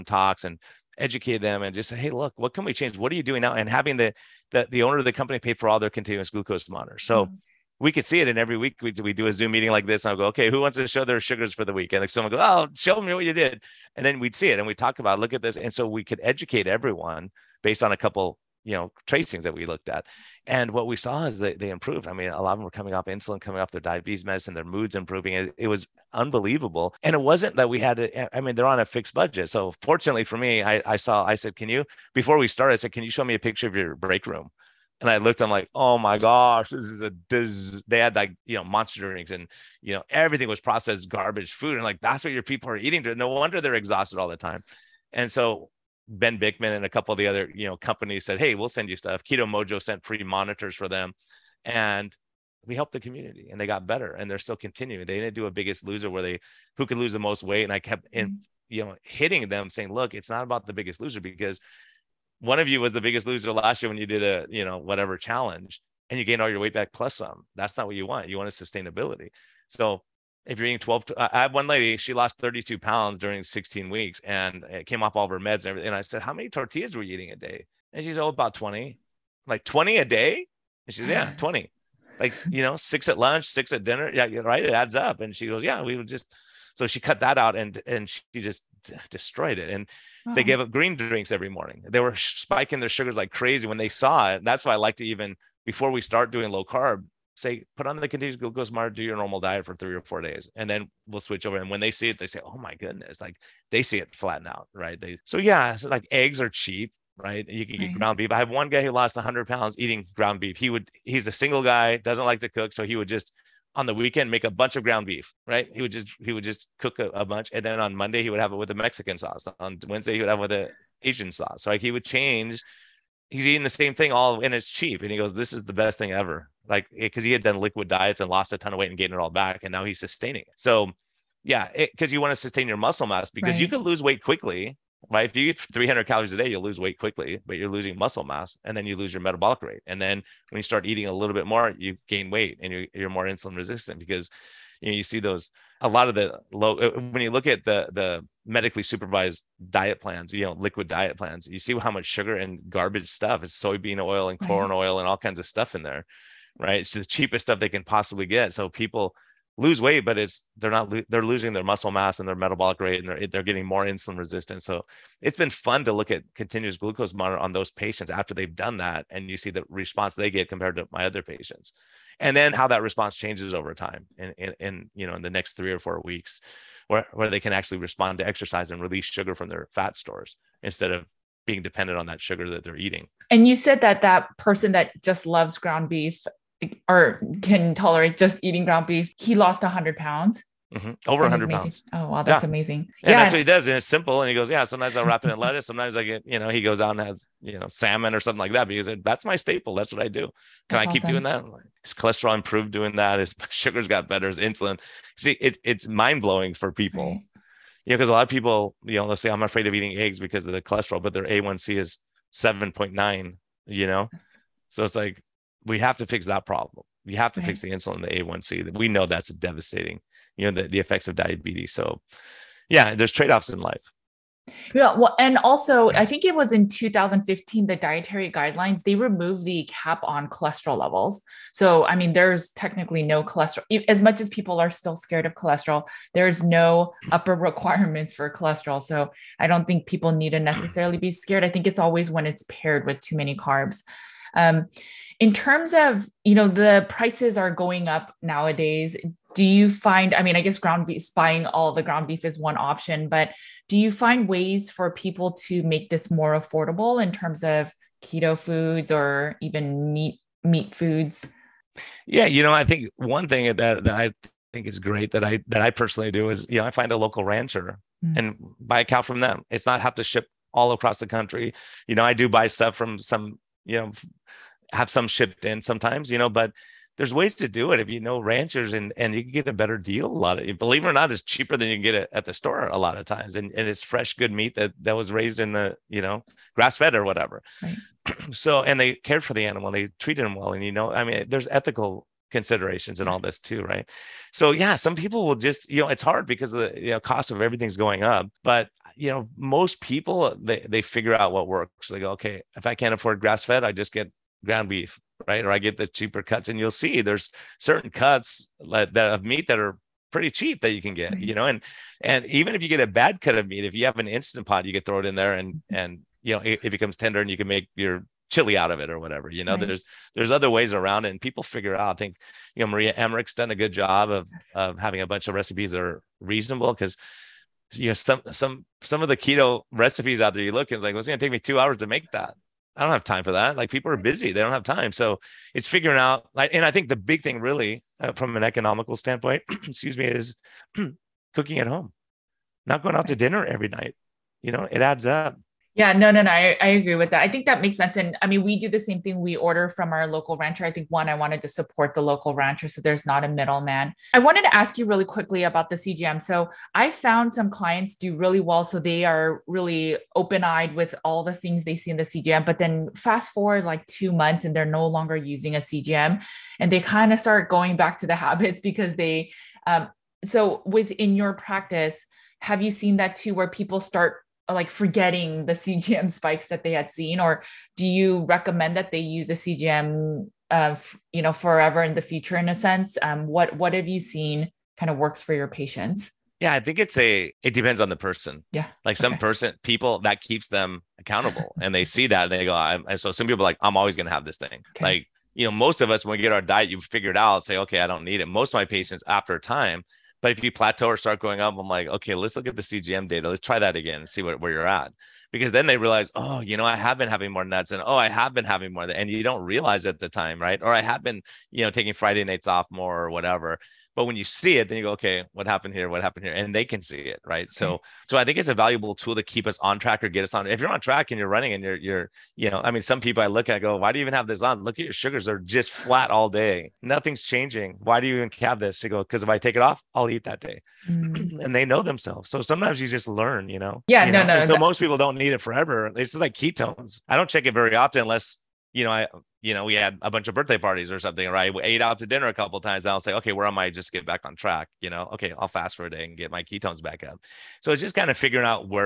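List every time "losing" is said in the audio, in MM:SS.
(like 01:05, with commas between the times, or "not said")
02:17, 02:41.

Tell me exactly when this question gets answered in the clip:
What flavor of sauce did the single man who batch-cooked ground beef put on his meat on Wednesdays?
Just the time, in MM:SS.
02:01.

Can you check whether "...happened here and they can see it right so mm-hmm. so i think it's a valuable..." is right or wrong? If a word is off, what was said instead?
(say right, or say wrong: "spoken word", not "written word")
right.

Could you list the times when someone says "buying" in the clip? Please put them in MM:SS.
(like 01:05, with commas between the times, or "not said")
04:11.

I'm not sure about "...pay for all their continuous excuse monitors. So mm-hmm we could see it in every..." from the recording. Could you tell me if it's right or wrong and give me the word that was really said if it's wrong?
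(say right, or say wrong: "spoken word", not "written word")
wrong: "glucose", not "excuse".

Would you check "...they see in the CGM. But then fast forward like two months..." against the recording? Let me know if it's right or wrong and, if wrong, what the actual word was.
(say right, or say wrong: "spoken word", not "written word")
right.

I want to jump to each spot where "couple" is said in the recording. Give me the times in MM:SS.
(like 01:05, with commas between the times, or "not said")
00:17, 00:46, 07:22.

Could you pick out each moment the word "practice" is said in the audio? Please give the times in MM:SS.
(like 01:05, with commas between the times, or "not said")
06:11.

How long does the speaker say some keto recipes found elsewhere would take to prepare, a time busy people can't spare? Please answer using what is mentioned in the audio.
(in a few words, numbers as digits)
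2 hours.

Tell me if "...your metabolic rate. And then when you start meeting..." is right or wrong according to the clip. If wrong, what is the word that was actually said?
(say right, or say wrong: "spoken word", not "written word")
wrong: "eating", not "meeting".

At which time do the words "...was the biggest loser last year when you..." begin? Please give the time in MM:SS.
01:02.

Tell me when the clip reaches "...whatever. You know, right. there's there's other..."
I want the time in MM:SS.
05:18.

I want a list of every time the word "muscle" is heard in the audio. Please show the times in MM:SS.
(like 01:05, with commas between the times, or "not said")
02:12, 02:17, 02:41.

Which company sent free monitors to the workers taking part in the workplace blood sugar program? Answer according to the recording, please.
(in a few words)
Keto Mojo.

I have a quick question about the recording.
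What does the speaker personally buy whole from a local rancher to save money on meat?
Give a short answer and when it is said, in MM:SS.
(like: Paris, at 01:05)
A cow, at 04:28.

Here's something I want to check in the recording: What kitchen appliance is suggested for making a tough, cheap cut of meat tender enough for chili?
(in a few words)
Instant Pot.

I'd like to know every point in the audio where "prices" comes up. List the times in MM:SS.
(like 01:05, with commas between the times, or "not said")
04:06.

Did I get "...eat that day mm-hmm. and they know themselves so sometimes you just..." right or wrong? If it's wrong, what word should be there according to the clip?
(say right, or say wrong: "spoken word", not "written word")
right.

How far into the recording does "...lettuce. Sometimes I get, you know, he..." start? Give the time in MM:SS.
03:15.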